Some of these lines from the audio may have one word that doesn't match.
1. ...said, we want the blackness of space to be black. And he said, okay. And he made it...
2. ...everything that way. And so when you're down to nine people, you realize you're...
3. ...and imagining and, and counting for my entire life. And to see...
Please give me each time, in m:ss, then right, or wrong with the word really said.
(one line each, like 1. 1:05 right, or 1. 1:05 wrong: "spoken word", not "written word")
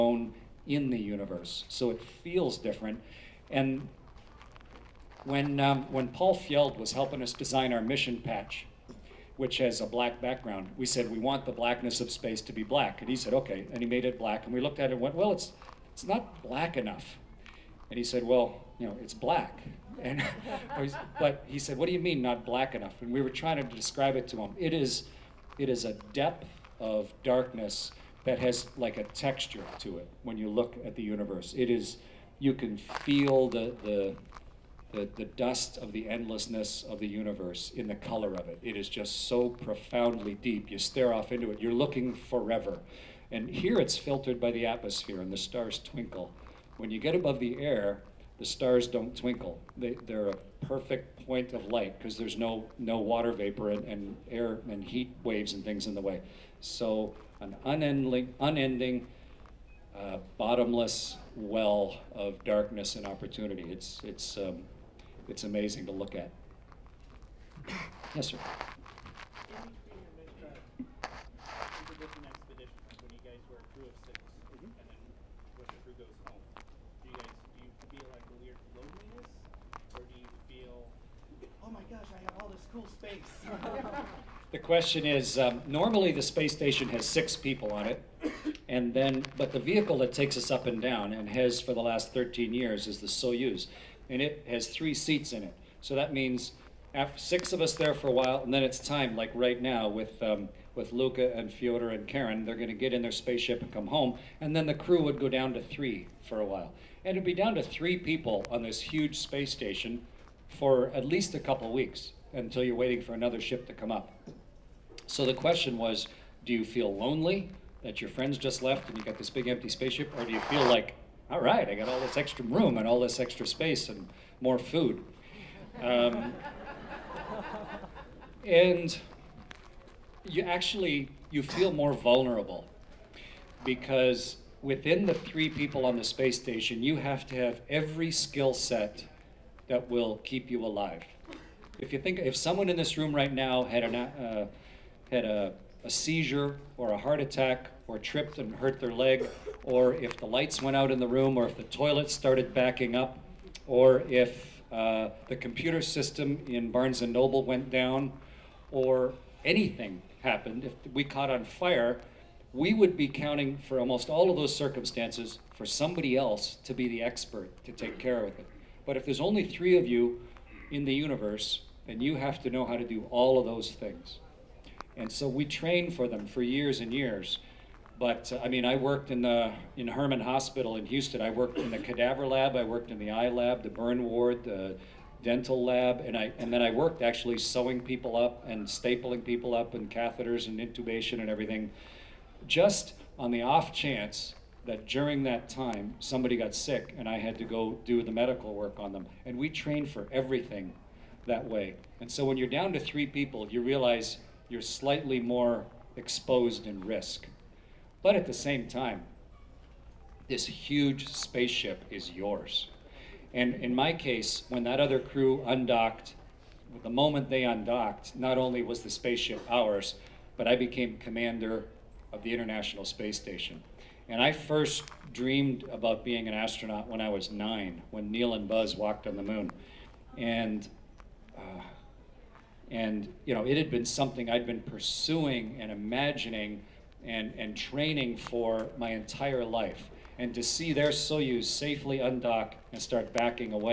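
1. 0:10 right
2. 3:20 wrong: "three", not "nine"
3. 3:55 wrong: "training", not "counting".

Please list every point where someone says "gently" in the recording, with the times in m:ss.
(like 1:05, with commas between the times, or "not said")
not said.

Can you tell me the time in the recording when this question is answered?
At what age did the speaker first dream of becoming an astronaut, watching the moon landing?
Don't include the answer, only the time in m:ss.
3:47.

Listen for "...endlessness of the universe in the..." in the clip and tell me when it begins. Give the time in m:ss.
0:36.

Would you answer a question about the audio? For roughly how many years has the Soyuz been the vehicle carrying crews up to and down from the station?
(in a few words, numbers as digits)
13.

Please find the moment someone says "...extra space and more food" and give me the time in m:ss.
2:03.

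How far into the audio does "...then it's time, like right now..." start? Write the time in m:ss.
1:38.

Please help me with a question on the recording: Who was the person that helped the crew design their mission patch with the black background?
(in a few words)
Paul Fjeld.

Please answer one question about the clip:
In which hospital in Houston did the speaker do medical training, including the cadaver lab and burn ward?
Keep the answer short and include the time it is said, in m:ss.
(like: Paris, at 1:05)
Hermann Hospital, at 2:59.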